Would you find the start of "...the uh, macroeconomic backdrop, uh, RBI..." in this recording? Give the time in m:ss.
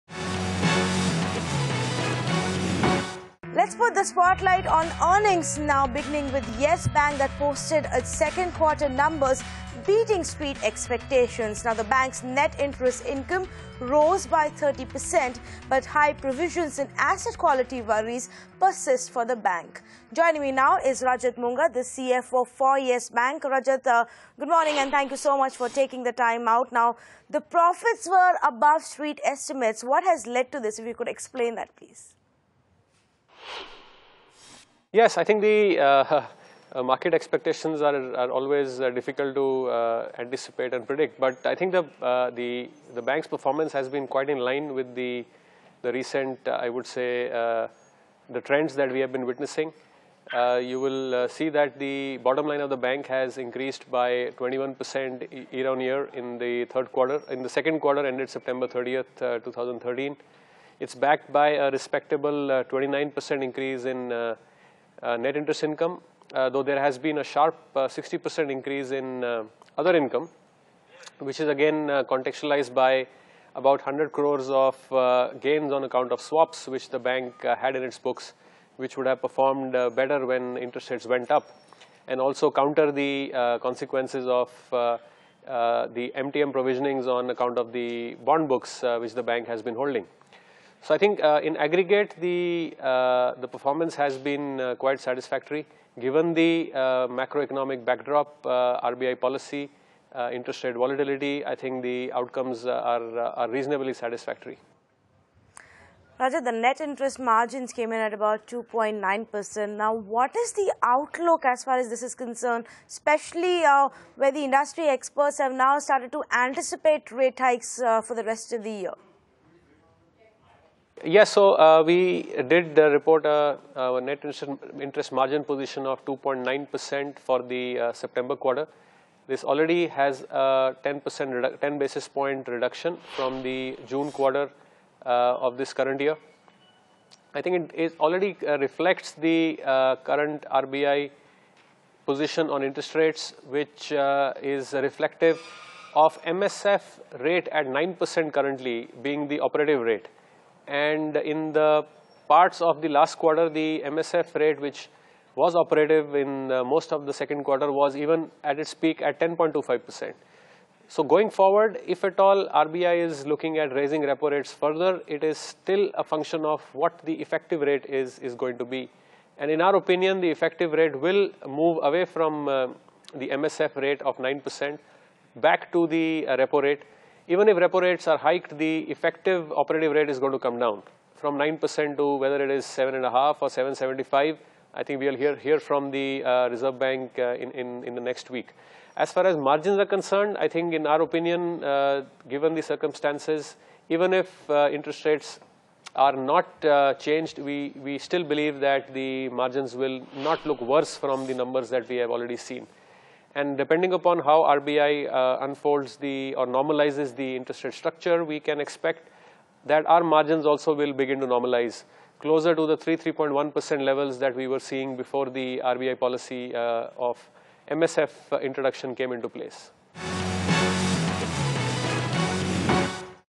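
1:36.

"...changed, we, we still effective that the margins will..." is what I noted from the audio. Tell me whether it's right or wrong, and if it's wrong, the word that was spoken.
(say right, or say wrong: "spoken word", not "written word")
wrong: "believe", not "effective".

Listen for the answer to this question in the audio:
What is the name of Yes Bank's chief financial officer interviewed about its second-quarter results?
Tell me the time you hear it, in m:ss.
0:21.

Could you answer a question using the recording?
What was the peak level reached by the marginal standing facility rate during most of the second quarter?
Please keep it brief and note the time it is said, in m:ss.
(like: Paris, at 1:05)
10.25%, at 2:39.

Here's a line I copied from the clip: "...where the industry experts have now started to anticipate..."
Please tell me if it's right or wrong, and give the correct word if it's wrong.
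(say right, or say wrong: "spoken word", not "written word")
right.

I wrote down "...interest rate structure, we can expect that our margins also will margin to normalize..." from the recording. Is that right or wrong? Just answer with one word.
wrong.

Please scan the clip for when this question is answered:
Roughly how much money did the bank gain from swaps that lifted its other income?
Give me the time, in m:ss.
1:13.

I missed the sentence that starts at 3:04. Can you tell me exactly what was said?
I think we'll hear, hear from the uh, Reserve Bank uh, in, in, in the next week.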